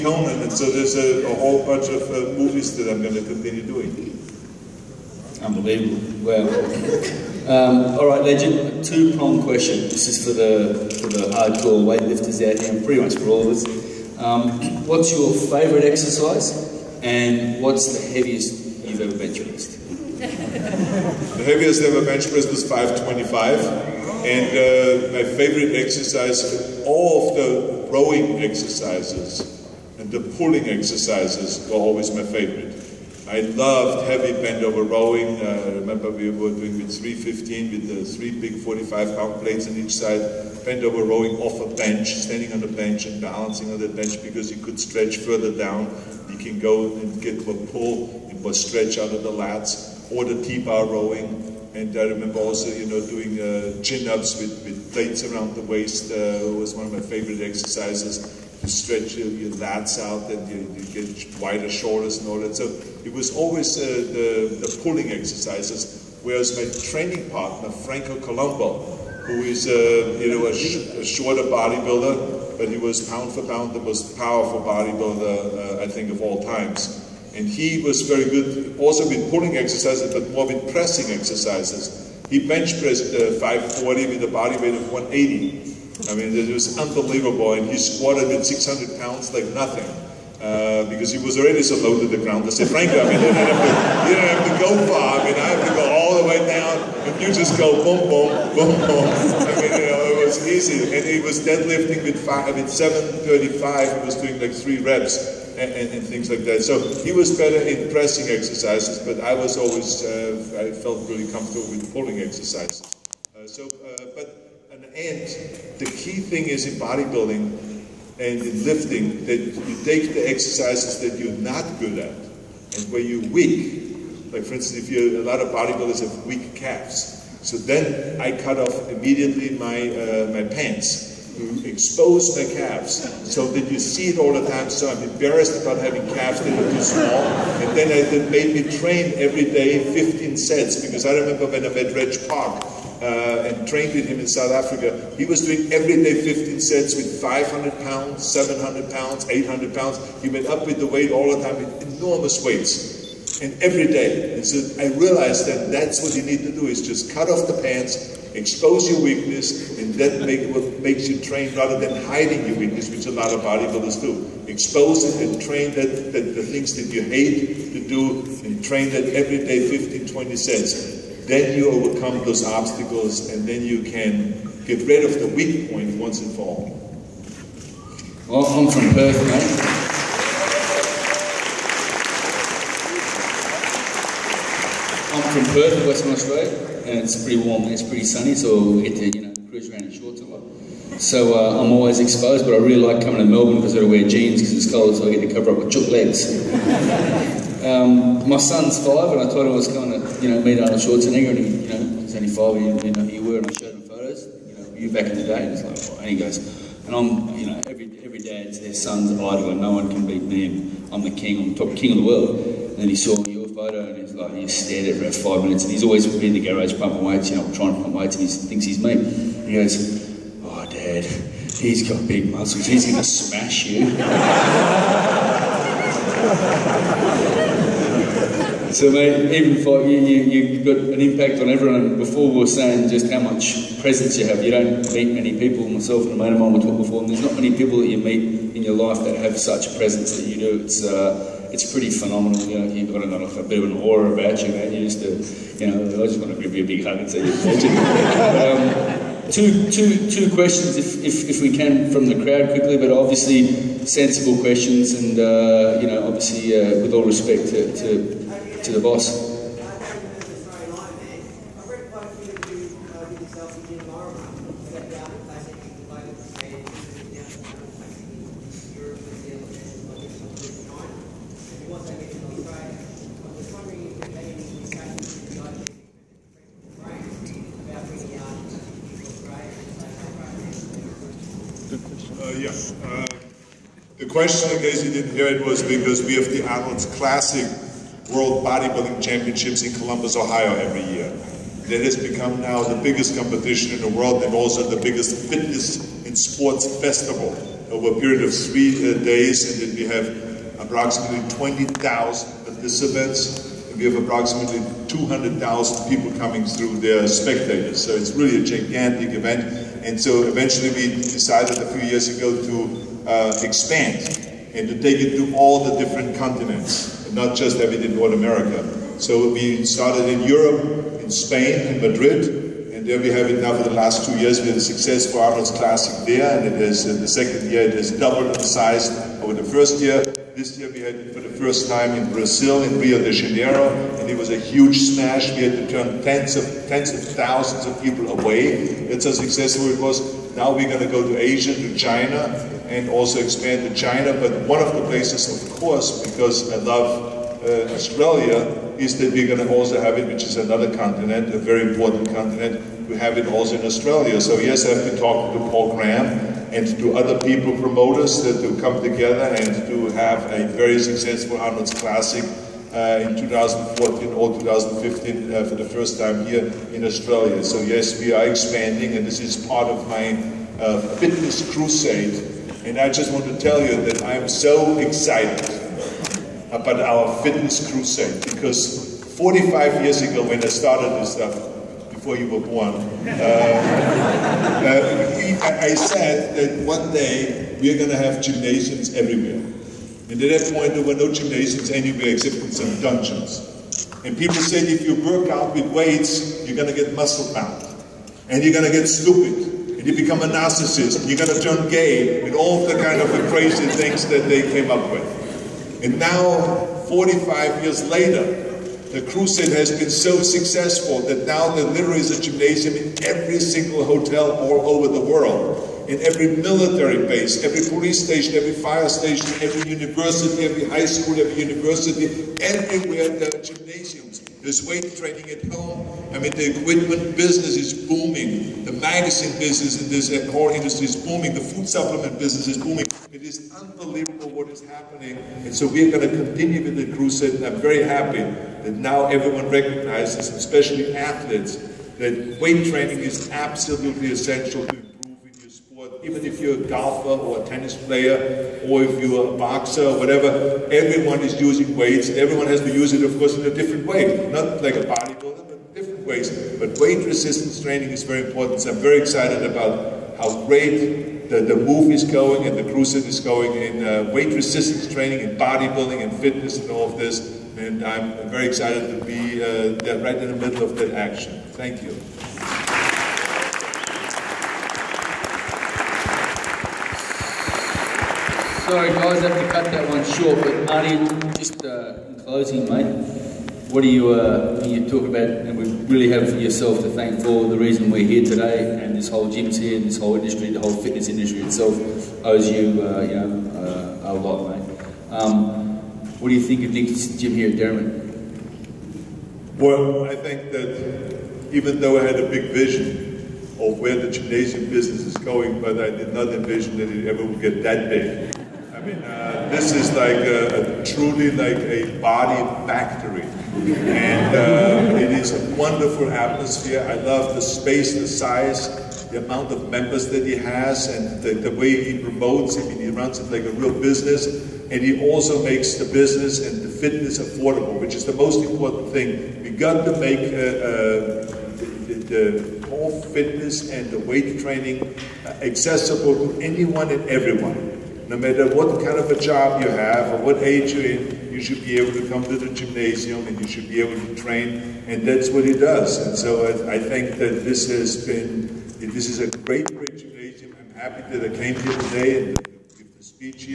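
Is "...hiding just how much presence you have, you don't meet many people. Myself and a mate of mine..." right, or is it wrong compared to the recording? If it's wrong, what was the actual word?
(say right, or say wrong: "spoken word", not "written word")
wrong: "saying", not "hiding".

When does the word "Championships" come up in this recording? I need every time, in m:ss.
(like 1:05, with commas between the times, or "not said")
4:49.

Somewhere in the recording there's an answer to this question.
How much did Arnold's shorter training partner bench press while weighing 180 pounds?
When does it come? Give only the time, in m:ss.
1:23.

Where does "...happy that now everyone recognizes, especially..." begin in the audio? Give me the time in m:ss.
7:17.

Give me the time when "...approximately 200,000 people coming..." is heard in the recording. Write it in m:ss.
5:04.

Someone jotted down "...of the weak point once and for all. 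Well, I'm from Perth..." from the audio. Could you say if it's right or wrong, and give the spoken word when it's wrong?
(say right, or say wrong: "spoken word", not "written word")
right.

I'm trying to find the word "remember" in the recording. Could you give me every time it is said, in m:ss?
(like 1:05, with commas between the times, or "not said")
0:35, 0:52, 2:21.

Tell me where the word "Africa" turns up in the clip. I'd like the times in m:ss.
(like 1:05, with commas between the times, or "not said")
2:24.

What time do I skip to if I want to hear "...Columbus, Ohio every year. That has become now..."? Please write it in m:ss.
4:49.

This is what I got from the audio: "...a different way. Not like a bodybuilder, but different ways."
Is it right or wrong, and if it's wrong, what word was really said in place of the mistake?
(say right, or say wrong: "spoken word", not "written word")
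right.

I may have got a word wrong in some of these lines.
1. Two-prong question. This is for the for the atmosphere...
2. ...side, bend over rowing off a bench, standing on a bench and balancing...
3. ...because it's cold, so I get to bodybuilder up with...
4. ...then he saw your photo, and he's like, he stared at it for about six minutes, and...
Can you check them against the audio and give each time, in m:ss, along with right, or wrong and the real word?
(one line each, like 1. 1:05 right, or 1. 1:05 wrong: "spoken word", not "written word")
1. 0:08 wrong: "hardcore", not "atmosphere"
2. 0:39 right
3. 3:14 wrong: "cover", not "bodybuilder"
4. 3:32 wrong: "five", not "six".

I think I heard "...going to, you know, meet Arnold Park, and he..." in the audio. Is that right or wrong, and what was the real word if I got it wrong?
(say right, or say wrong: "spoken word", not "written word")
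wrong: "Schwarzenegger", not "Park".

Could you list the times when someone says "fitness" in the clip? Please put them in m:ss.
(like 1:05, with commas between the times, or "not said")
4:55, 6:10, 6:17, 7:46, 8:10, 8:46, 8:53.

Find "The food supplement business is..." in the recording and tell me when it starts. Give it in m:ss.
7:11.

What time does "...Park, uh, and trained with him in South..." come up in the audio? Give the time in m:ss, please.
2:22.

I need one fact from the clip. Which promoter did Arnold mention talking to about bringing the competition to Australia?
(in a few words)
Paul Graham.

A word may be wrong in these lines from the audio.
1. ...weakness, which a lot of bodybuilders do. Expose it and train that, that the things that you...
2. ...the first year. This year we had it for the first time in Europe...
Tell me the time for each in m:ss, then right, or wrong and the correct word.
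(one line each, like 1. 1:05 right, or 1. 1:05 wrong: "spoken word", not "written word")
1. 2:42 right
2. 5:29 wrong: "Brazil", not "Europe".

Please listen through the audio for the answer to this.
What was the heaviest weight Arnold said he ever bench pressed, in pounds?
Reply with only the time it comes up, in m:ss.
0:22.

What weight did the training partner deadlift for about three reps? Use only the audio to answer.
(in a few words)
735.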